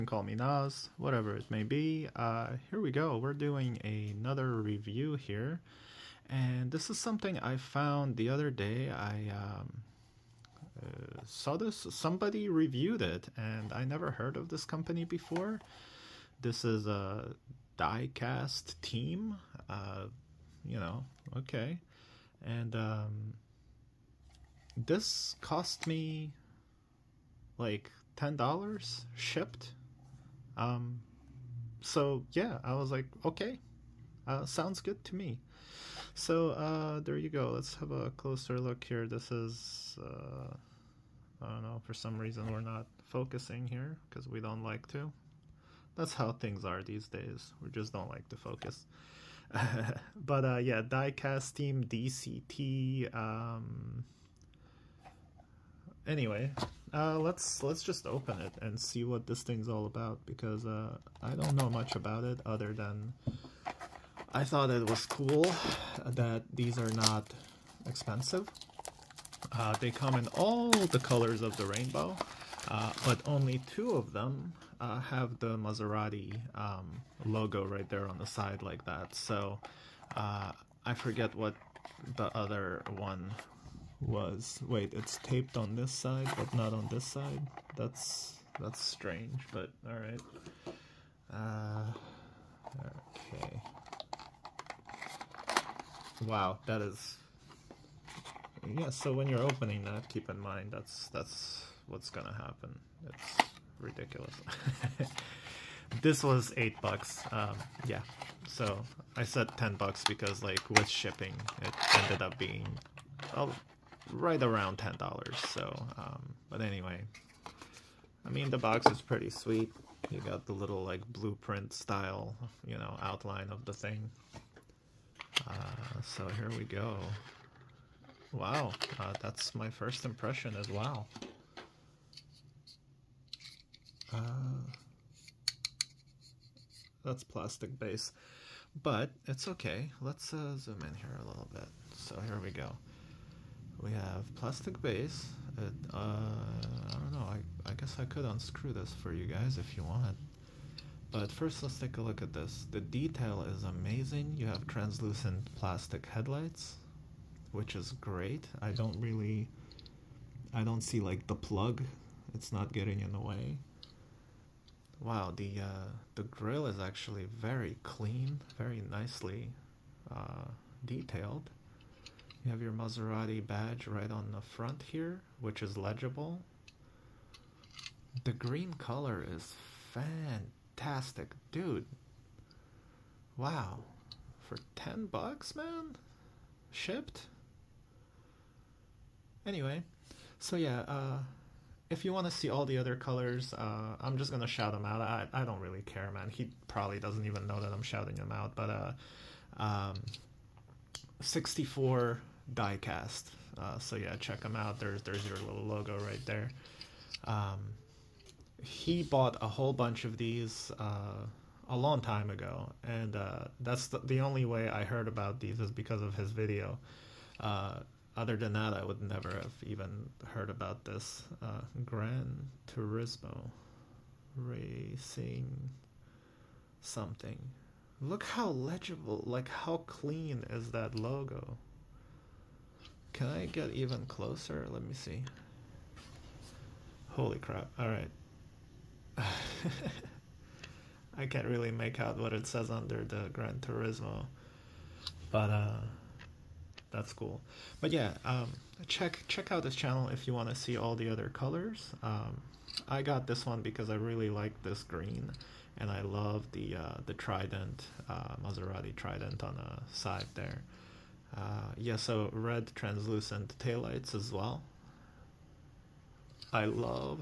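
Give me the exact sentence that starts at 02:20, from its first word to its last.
Let's uh, zoom in here a little bit.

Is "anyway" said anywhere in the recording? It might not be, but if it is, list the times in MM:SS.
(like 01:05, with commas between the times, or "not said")
00:56, 01:56, 03:09.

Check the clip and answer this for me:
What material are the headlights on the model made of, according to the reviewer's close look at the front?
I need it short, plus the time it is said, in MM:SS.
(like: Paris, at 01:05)
Translucent plastic, at 02:34.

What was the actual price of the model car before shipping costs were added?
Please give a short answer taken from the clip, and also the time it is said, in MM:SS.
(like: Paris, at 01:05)
$8, at 01:46.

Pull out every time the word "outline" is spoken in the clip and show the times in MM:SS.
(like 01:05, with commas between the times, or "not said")
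02:03.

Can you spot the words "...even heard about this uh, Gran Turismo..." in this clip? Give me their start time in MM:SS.
03:39.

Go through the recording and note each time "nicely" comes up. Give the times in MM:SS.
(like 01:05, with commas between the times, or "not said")
02:48.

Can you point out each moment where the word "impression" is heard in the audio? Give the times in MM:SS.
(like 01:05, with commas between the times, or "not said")
02:10.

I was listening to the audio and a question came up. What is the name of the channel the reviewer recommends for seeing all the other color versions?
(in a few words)
64 diecast.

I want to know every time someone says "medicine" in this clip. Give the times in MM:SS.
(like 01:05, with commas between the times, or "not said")
not said.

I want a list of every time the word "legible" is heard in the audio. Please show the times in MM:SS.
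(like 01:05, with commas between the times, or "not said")
02:55, 03:48.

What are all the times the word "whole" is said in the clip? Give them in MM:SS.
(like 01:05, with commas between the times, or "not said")
03:29.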